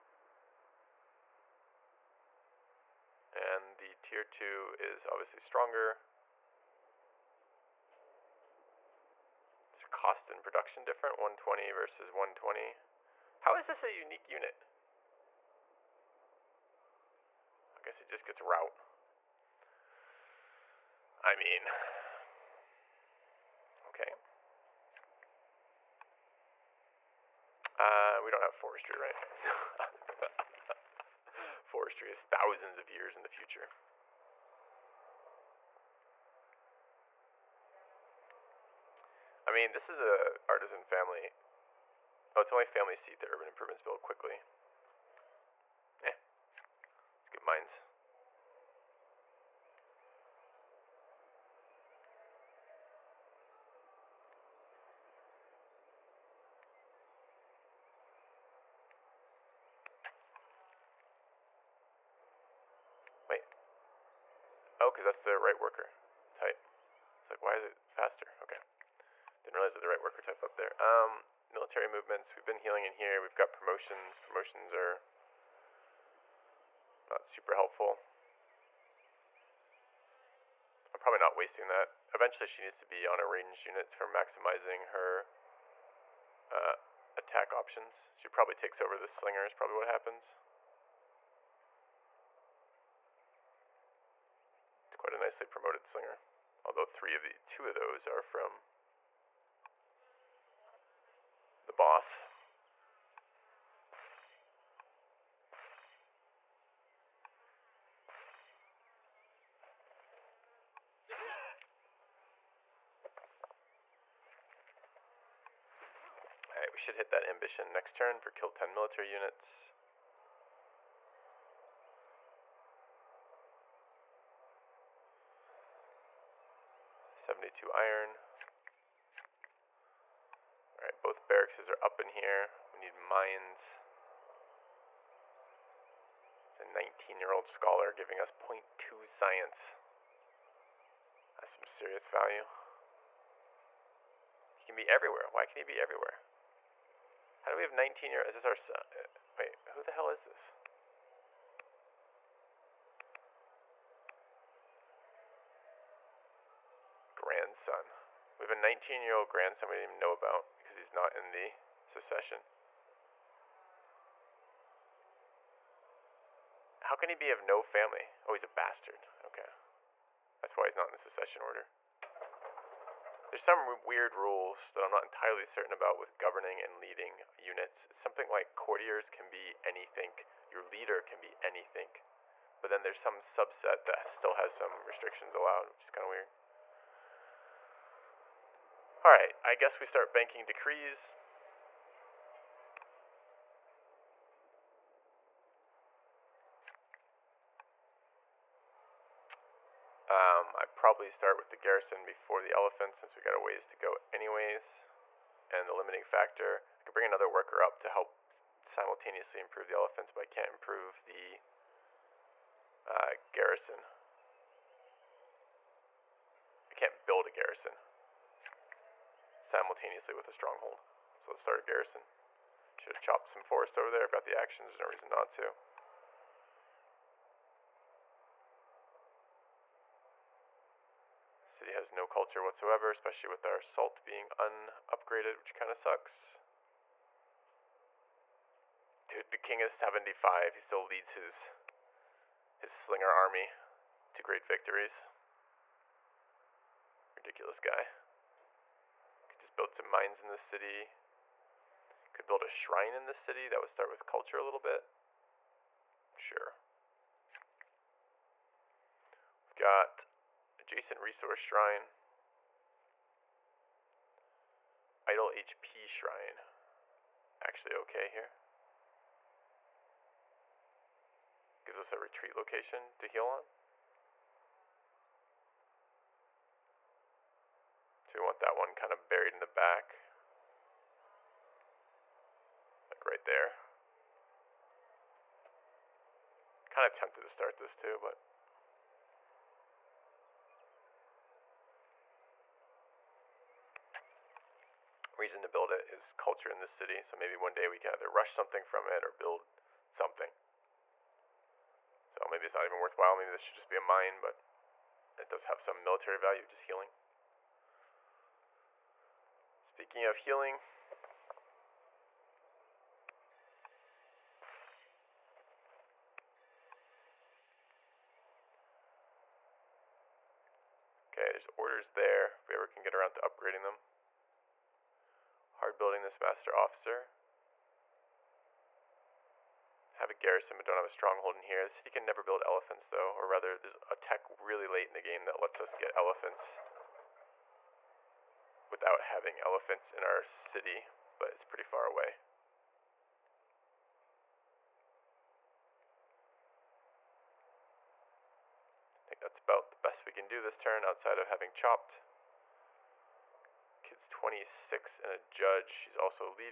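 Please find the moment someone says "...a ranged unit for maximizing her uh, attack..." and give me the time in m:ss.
1:23.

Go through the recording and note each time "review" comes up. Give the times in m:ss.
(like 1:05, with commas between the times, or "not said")
not said.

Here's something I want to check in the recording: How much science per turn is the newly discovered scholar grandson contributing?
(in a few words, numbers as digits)
0.2.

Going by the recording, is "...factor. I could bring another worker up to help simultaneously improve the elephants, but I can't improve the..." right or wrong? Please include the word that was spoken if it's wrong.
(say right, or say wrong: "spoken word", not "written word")
right.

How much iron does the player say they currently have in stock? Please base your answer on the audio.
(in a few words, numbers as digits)
72.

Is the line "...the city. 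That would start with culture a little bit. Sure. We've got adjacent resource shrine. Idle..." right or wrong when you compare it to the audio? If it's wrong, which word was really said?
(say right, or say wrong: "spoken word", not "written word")
right.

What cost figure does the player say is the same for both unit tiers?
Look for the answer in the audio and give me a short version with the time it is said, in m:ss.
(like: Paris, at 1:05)
120, at 0:11.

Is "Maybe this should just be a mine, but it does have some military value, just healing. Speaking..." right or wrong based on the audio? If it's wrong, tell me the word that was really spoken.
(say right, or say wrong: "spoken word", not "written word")
right.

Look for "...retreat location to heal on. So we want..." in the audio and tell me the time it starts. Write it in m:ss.
4:31.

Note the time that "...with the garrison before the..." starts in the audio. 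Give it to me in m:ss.
3:21.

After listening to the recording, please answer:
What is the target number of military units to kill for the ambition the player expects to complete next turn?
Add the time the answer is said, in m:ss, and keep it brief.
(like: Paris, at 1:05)
10, at 1:58.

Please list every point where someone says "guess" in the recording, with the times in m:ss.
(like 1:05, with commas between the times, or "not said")
0:17, 3:09.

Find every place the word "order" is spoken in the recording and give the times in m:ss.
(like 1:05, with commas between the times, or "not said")
2:51, 5:21.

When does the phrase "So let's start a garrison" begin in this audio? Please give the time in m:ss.
3:41.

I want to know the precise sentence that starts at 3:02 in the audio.
But then there's some subset that still has some restrictions allowed, which is kind of weird.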